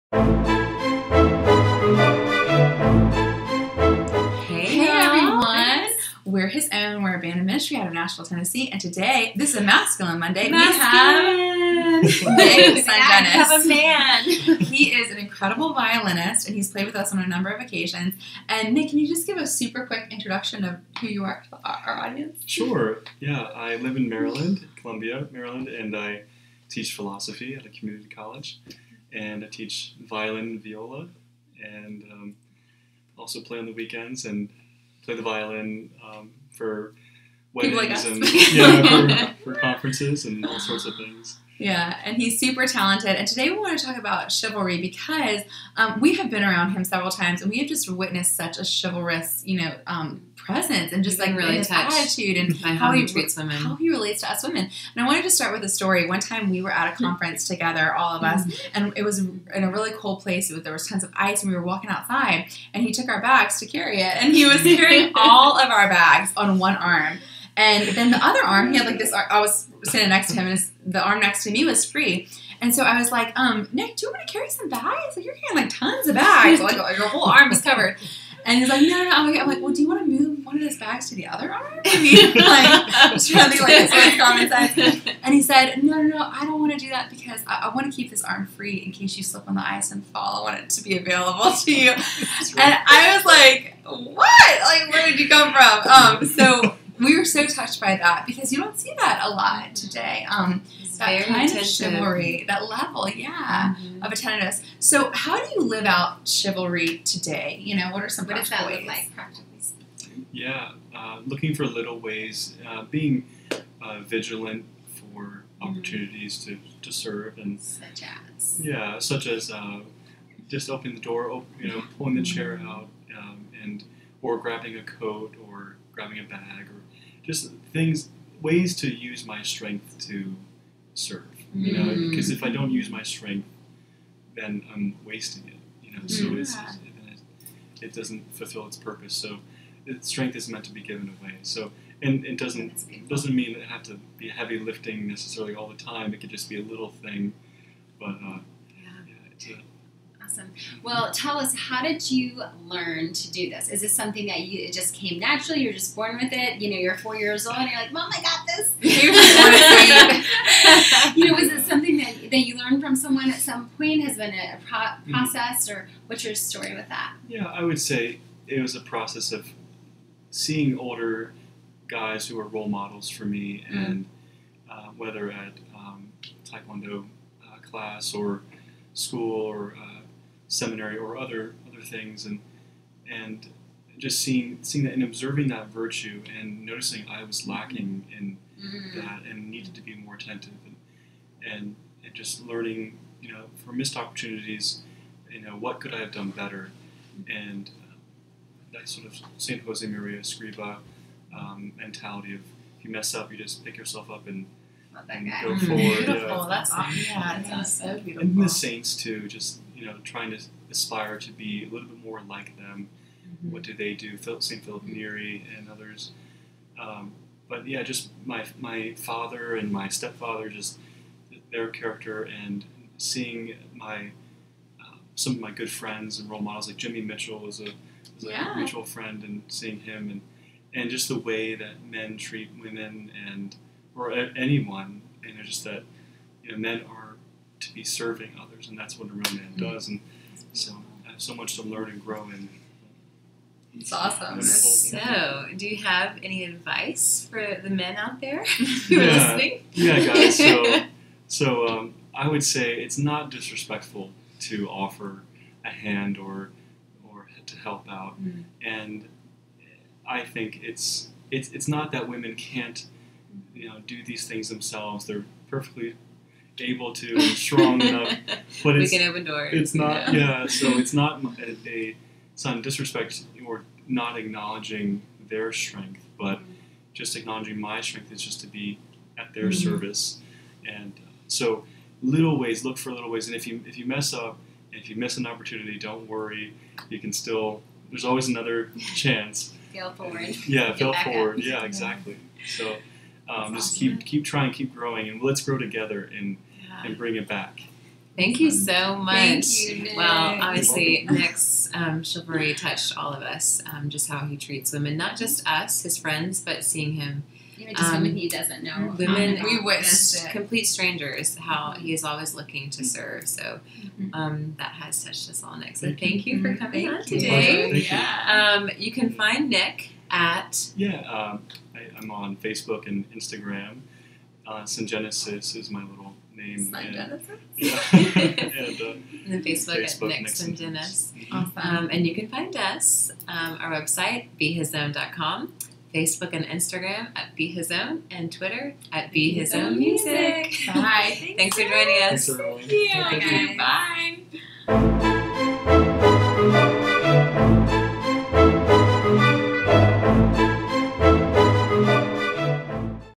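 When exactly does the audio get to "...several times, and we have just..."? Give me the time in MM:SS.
00:46.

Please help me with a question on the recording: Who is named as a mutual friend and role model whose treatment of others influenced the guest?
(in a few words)
Jimmy Mitchell.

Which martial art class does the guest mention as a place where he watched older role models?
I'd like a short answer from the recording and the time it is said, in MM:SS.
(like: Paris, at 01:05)
Taekwondo, at 02:56.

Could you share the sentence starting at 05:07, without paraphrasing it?
even just um, women he doesn't know.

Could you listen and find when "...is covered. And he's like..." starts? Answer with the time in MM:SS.
01:17.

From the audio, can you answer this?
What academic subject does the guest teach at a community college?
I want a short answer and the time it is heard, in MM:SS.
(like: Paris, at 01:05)
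Philosophy, at 00:25.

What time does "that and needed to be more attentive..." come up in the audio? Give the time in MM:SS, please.
03:08.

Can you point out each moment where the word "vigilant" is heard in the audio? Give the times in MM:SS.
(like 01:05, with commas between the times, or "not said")
01:54.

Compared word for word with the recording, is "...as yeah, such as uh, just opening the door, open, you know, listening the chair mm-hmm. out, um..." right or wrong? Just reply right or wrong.
wrong.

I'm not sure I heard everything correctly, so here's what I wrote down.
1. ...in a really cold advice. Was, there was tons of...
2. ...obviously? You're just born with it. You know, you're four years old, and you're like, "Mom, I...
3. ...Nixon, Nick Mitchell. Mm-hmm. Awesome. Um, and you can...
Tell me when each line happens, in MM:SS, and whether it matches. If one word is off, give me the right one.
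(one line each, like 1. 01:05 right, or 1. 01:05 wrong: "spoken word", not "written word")
1. 00:59 wrong: "place", not "advice"
2. 02:35 wrong: "naturally", not "obviously"
3. 05:30 wrong: "Sungenis", not "Mitchell".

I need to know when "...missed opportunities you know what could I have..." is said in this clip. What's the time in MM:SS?
03:13.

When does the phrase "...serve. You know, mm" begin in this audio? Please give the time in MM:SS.
02:10.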